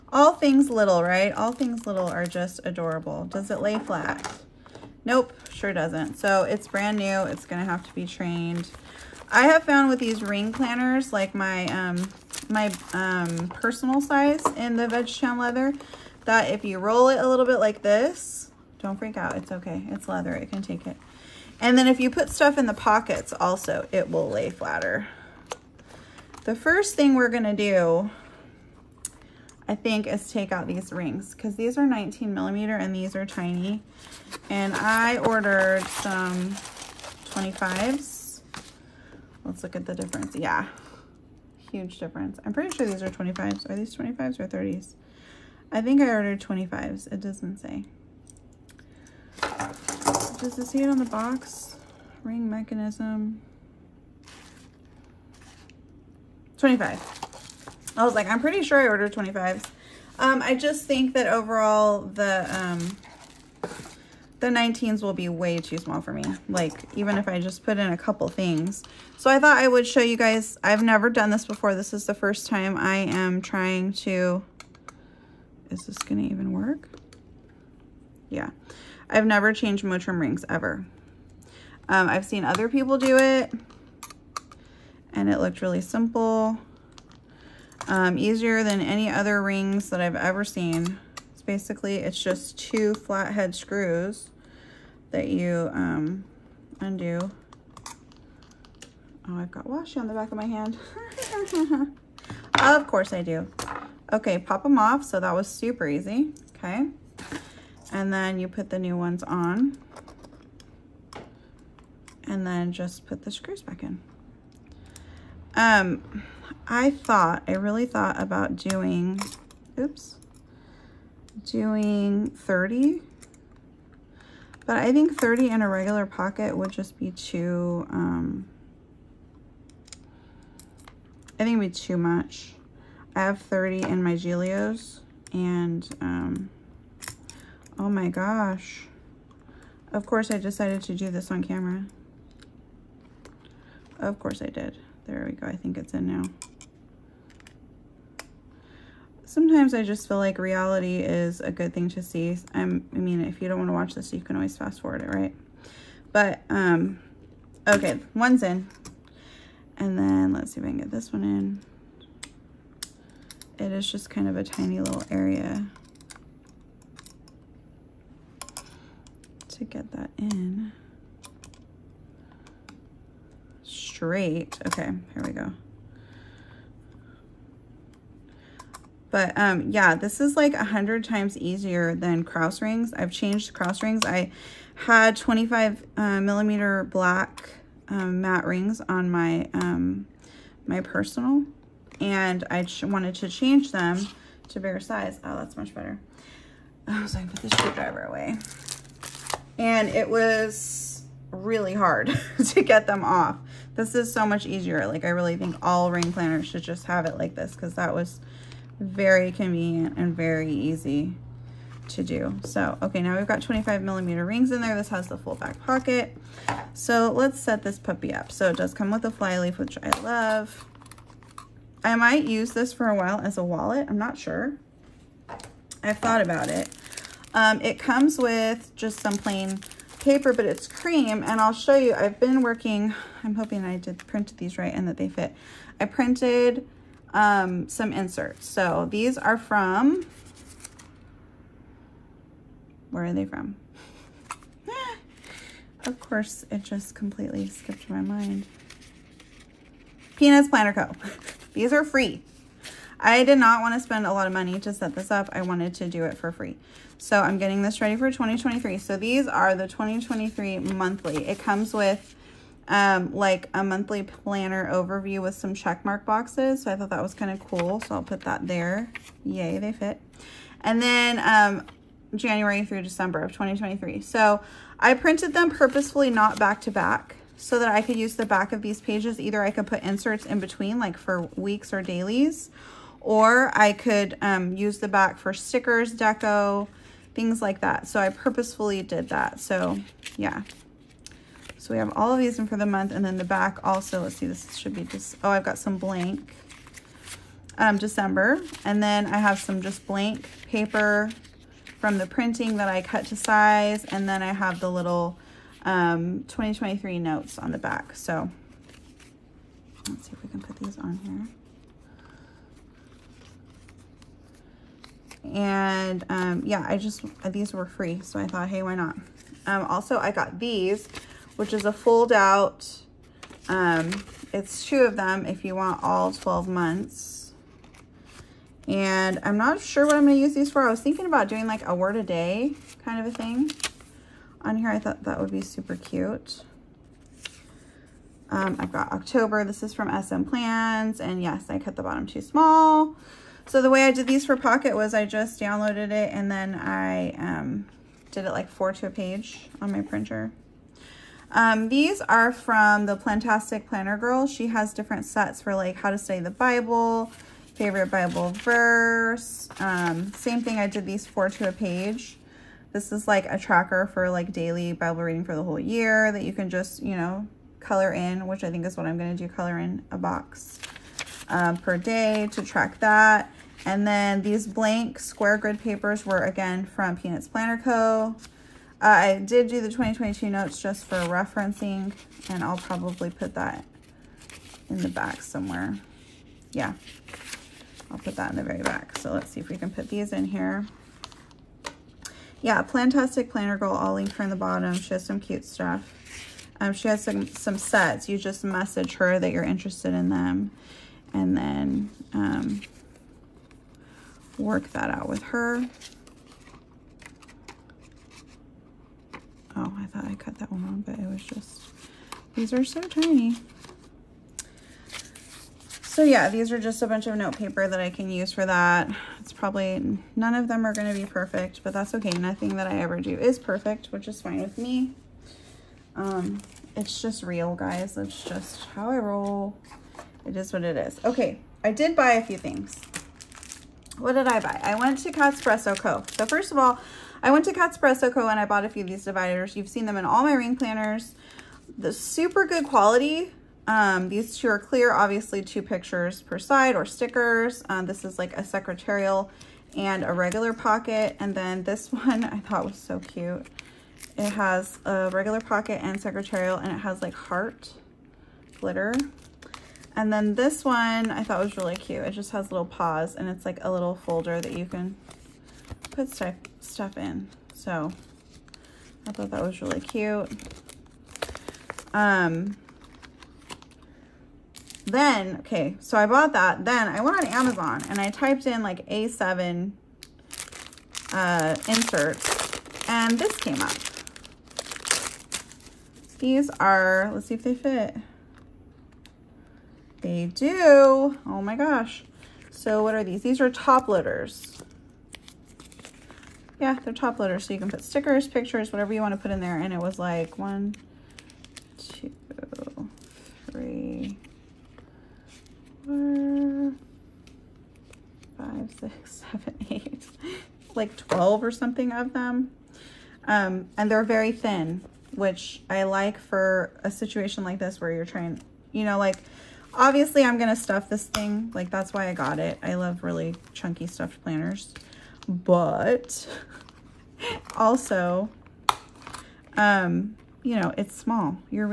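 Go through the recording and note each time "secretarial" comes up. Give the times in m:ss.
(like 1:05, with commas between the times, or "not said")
7:28, 7:36.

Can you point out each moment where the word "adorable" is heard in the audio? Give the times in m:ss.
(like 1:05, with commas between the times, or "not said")
0:02.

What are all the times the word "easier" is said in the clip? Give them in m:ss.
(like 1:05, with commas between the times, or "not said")
1:28, 3:01, 3:24.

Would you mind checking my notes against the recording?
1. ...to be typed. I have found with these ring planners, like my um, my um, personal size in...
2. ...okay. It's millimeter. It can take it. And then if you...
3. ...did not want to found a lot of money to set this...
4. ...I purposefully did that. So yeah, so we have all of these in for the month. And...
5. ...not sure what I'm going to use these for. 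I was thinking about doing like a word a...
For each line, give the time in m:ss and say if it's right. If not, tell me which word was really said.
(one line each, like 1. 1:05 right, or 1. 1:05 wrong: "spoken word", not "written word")
1. 0:07 wrong: "trained", not "typed"
2. 0:19 wrong: "leather", not "millimeter"
3. 4:13 wrong: "spend", not "found"
4. 4:47 right
5. 5:29 right.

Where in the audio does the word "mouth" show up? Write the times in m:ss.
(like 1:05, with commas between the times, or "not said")
not said.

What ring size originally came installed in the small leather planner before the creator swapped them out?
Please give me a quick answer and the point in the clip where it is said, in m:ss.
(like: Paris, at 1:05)
19 millimeter, at 0:31.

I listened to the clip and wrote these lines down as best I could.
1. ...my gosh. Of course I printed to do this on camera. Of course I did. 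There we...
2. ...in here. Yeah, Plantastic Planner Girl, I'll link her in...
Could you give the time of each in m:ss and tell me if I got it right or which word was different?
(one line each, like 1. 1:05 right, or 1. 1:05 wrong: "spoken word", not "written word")
1. 2:17 wrong: "decided", not "printed"
2. 6:30 right.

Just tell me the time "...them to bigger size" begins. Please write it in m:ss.
3:13.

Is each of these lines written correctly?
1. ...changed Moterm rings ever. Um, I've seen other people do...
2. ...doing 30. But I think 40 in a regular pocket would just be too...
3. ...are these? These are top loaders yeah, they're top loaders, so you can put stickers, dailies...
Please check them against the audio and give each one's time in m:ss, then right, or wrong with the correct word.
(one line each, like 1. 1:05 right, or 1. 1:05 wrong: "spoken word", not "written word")
1. 1:19 right
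2. 2:01 wrong: "30", not "40"
3. 8:12 wrong: "pictures", not "dailies".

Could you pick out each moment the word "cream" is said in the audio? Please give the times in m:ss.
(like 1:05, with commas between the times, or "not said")
3:50.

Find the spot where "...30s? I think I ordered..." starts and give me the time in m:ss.
0:44.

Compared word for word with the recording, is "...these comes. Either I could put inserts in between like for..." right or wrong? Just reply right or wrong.
wrong.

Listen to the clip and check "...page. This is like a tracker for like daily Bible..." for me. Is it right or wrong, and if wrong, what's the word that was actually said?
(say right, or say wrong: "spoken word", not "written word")
right.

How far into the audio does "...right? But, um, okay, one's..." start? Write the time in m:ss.
2:35.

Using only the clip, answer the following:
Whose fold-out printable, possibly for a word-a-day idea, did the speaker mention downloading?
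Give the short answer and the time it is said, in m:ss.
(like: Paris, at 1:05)
SM Plans, at 5:40.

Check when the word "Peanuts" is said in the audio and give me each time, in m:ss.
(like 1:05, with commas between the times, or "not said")
4:10, 6:16.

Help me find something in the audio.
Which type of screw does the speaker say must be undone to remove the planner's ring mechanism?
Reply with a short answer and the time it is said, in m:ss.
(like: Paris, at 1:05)
flathead, at 1:32.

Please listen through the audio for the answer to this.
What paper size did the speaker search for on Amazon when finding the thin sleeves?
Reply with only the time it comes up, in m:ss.
7:58.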